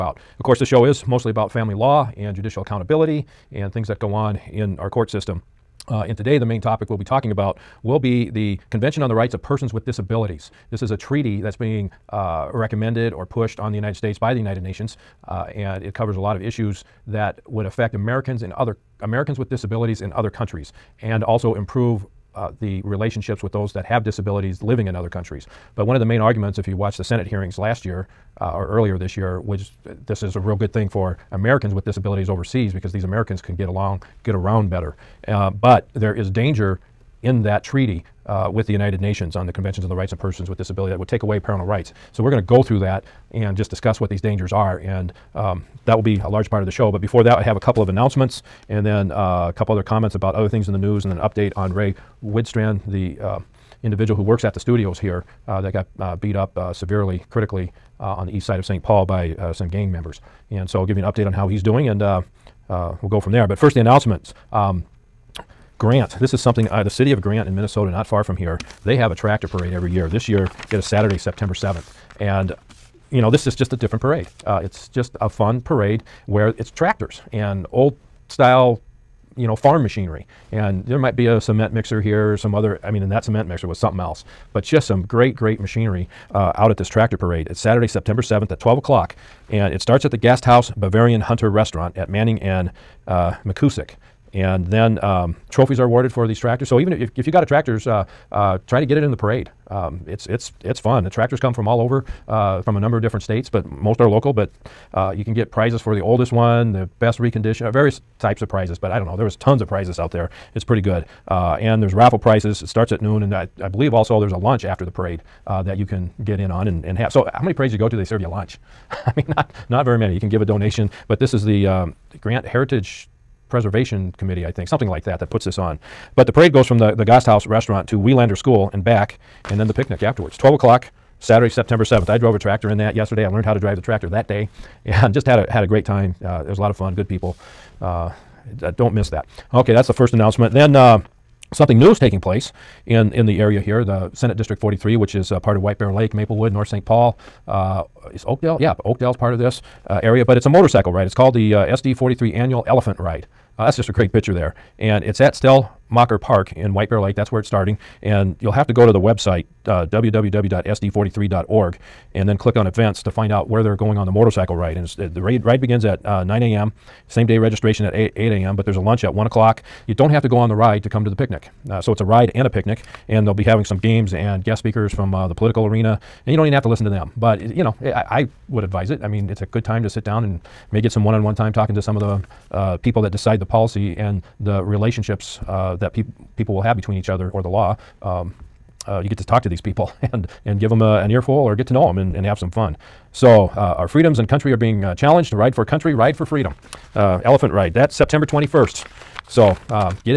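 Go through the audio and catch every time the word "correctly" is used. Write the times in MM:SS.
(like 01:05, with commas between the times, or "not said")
not said.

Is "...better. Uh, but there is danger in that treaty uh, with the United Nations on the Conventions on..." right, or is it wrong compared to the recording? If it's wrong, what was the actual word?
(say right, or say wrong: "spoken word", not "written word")
right.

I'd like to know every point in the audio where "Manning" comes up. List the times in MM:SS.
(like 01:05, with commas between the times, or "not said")
01:32.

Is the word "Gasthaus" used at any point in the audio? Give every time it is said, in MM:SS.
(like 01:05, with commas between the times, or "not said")
01:30, 02:07.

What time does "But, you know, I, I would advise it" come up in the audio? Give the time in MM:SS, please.
02:57.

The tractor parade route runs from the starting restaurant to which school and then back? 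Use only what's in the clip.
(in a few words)
Wielander School.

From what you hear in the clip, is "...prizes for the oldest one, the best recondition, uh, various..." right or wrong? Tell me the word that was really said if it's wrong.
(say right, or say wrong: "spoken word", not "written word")
right.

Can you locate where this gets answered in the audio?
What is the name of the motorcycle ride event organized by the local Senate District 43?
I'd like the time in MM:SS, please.
02:31.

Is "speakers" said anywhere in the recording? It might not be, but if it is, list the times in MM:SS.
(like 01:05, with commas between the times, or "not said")
02:54.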